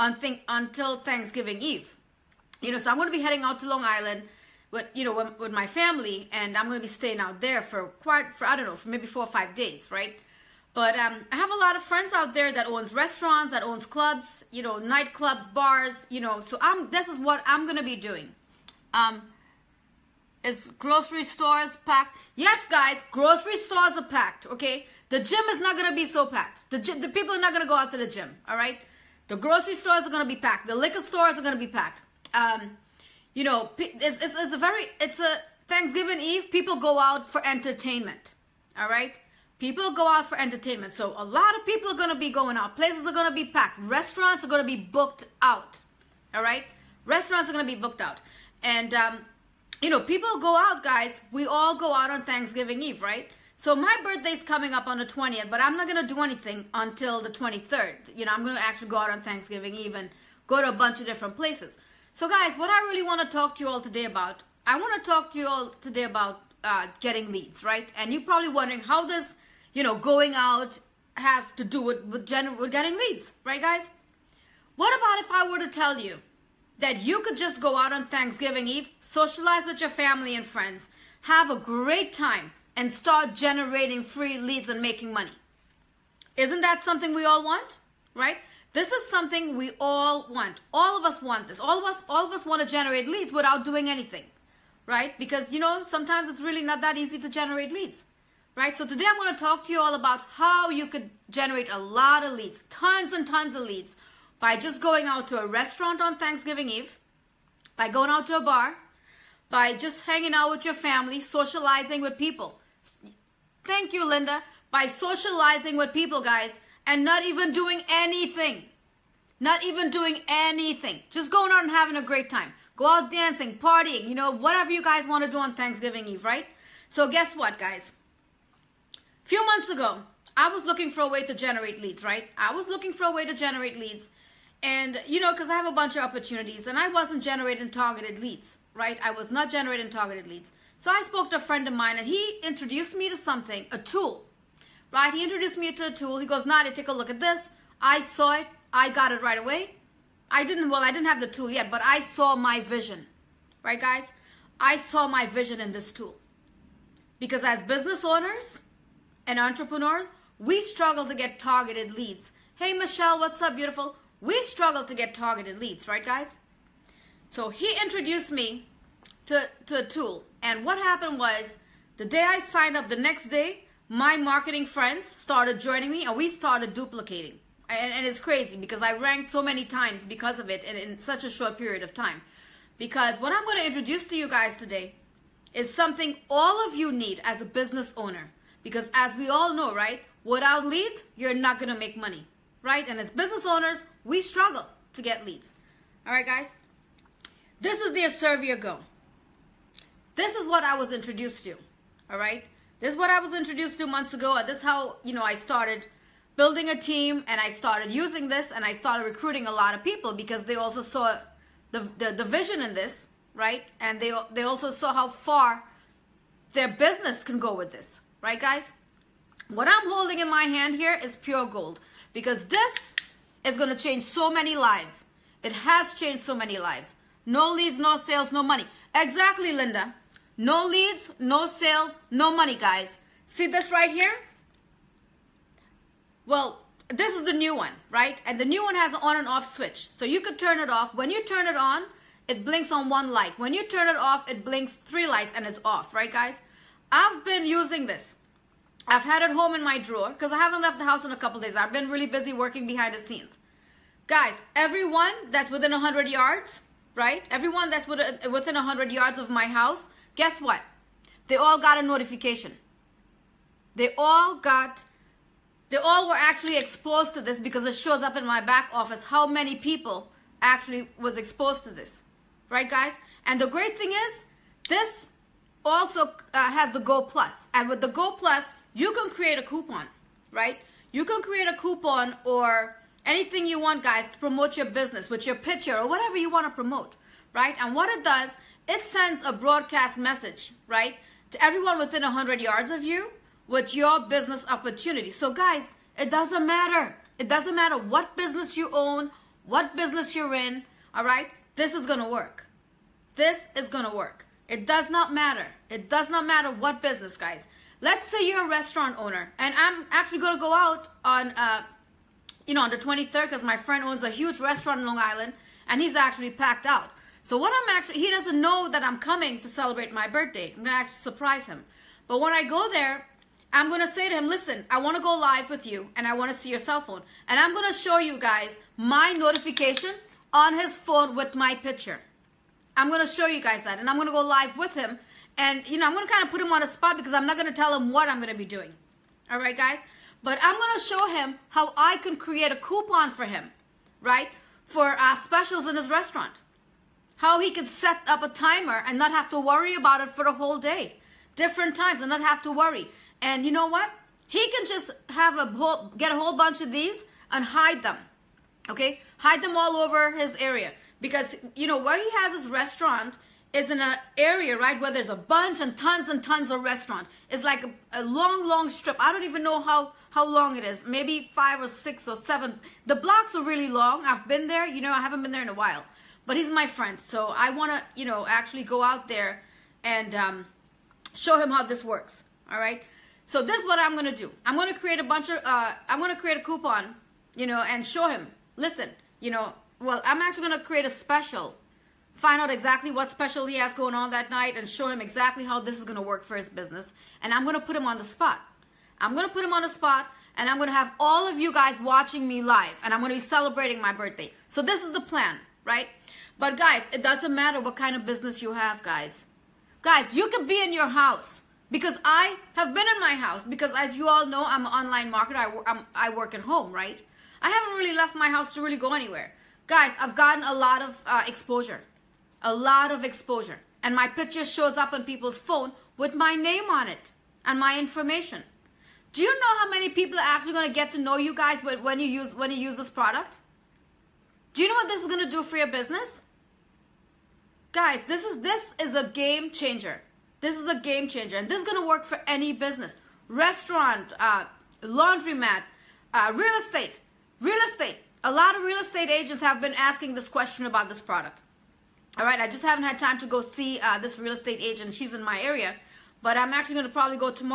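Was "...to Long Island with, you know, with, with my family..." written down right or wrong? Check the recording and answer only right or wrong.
right.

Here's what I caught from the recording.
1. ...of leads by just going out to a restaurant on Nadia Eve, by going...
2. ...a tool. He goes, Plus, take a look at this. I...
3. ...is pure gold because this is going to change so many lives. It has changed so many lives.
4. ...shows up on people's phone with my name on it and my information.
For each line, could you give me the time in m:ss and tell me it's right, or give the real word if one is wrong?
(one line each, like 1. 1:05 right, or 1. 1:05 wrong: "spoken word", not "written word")
1. 1:43 wrong: "Thanksgiving", not "Nadia"
2. 2:25 wrong: "Nadia", not "Plus"
3. 3:41 right
4. 7:04 right.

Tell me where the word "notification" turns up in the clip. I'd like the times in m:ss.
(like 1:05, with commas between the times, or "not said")
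4:21, 5:29.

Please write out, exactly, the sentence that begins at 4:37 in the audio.
And with the Go Plus, you can create a coupon, right?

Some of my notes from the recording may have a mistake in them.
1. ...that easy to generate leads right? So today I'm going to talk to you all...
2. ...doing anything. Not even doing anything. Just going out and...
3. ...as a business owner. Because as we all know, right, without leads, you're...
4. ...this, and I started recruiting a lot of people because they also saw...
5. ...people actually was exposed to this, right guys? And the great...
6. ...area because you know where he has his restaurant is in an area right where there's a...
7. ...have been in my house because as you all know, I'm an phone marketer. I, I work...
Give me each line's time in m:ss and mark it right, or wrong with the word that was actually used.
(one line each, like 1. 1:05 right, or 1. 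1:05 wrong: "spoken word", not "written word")
1. 1:36 right
2. 1:57 right
3. 3:07 right
4. 3:28 right
5. 4:29 right
6. 6:00 right
7. 6:52 wrong: "online", not "phone".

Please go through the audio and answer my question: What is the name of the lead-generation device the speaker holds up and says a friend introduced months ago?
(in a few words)
Aservia Go.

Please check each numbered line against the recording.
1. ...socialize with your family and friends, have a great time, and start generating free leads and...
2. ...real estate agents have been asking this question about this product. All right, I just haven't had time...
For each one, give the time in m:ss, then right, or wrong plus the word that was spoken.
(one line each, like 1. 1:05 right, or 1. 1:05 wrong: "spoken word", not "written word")
1. 1:19 right
2. 7:28 right.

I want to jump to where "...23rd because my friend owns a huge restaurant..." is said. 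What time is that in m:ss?
5:12.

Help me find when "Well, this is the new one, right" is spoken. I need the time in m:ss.
3:56.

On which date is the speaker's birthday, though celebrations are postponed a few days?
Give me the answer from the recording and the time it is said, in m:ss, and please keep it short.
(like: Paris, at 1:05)
20th, at 0:55.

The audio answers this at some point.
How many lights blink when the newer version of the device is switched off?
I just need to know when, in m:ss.
4:04.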